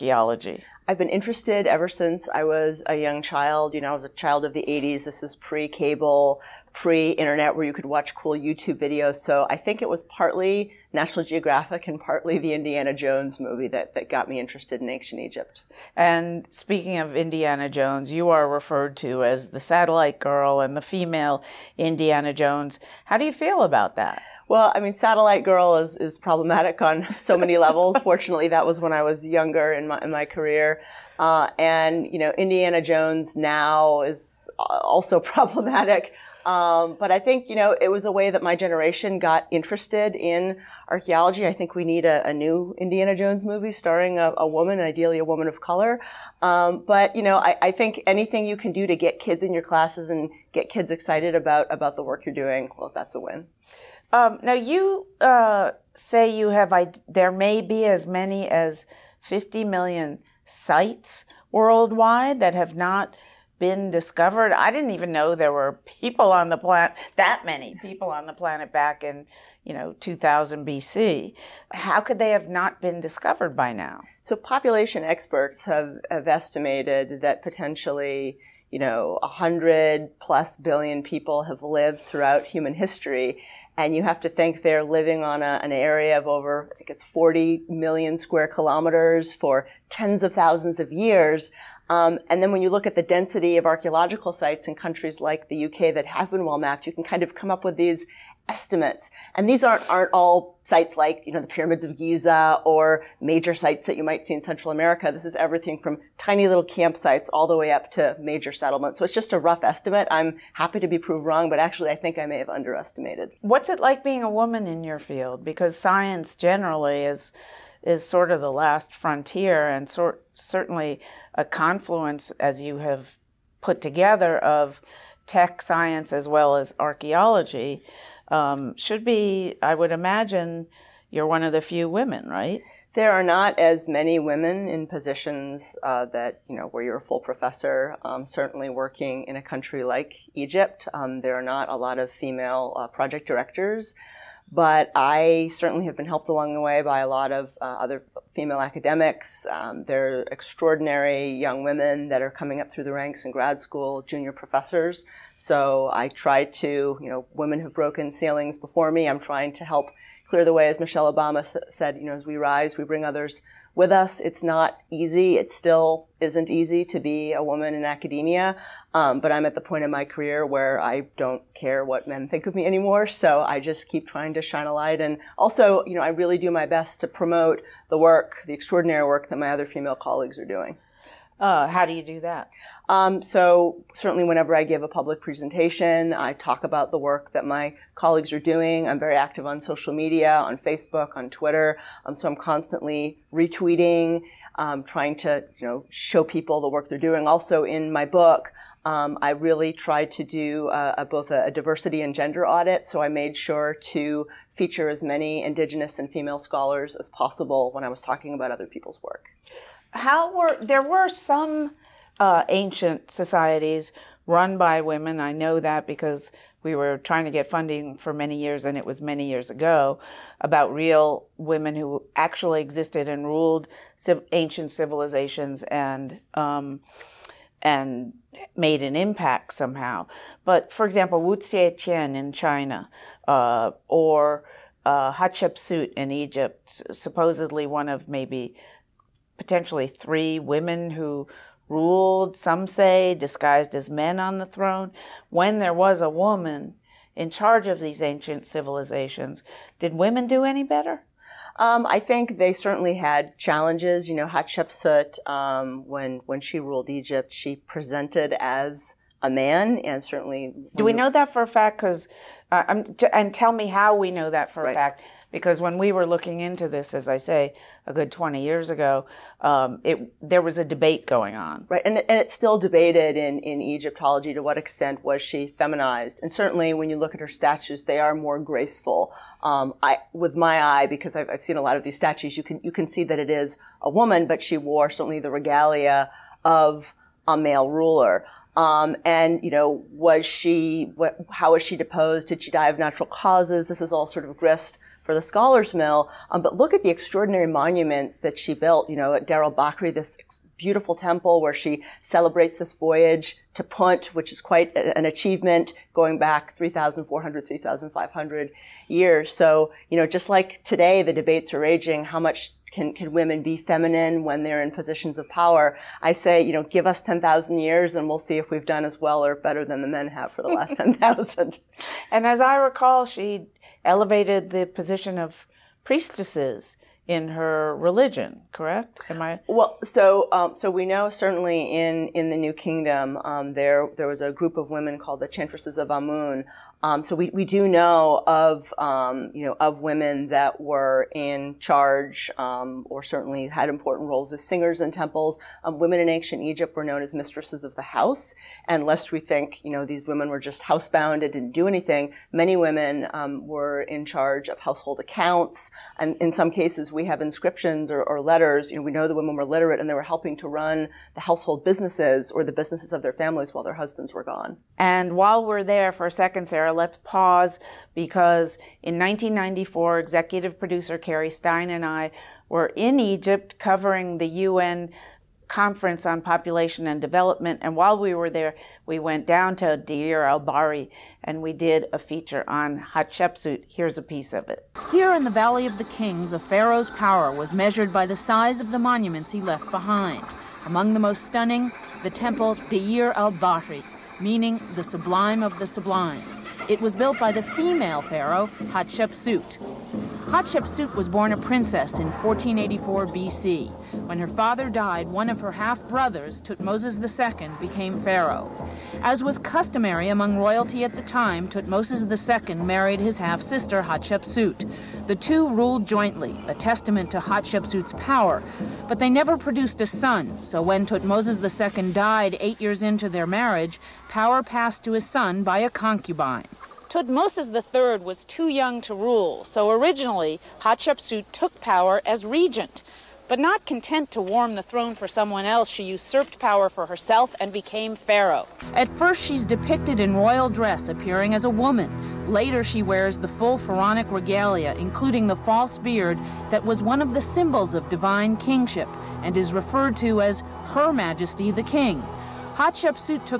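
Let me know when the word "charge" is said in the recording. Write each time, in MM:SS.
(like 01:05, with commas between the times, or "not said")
04:07, 05:41, 05:54.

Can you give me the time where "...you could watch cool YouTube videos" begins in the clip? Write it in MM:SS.
00:07.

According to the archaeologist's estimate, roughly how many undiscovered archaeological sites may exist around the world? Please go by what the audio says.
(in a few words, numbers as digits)
50 million.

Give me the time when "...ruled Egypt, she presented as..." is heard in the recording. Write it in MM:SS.
04:16.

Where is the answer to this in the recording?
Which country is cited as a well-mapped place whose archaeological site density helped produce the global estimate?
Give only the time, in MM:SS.
01:35.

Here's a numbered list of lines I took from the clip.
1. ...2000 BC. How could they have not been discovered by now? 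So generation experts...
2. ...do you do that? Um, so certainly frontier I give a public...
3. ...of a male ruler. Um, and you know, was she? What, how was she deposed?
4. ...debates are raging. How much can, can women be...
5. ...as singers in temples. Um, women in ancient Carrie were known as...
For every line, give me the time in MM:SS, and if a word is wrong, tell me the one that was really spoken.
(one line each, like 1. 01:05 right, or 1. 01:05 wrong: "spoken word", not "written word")
1. 01:09 wrong: "population", not "generation"
2. 03:01 wrong: "whenever", not "frontier"
3. 04:46 right
4. 05:11 right
5. 05:44 wrong: "Egypt", not "Carrie".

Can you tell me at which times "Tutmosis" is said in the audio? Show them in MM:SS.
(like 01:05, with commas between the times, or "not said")
06:46, 06:51, 07:00, 07:06.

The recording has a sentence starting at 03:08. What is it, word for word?
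I'm very active on social media, on Facebook, on Twitter.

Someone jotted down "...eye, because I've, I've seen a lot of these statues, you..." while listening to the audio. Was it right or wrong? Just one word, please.
right.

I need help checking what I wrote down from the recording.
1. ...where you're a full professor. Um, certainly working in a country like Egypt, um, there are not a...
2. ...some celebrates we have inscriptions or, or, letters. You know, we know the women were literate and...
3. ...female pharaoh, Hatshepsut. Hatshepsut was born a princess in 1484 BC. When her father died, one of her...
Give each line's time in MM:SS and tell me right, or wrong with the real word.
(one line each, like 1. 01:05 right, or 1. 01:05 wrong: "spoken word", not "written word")
1. 02:16 right
2. 05:56 wrong: "cases", not "celebrates"
3. 06:37 right.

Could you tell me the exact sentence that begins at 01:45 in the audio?
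This is everything from tiny little campsites all the way up to major settlements.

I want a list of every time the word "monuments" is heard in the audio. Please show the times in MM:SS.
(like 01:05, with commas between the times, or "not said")
04:57, 06:28.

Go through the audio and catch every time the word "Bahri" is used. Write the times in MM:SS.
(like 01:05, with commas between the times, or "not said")
04:59, 06:20, 06:33.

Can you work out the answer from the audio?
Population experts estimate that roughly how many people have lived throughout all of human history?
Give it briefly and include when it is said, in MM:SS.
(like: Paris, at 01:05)
100 billion, at 01:19.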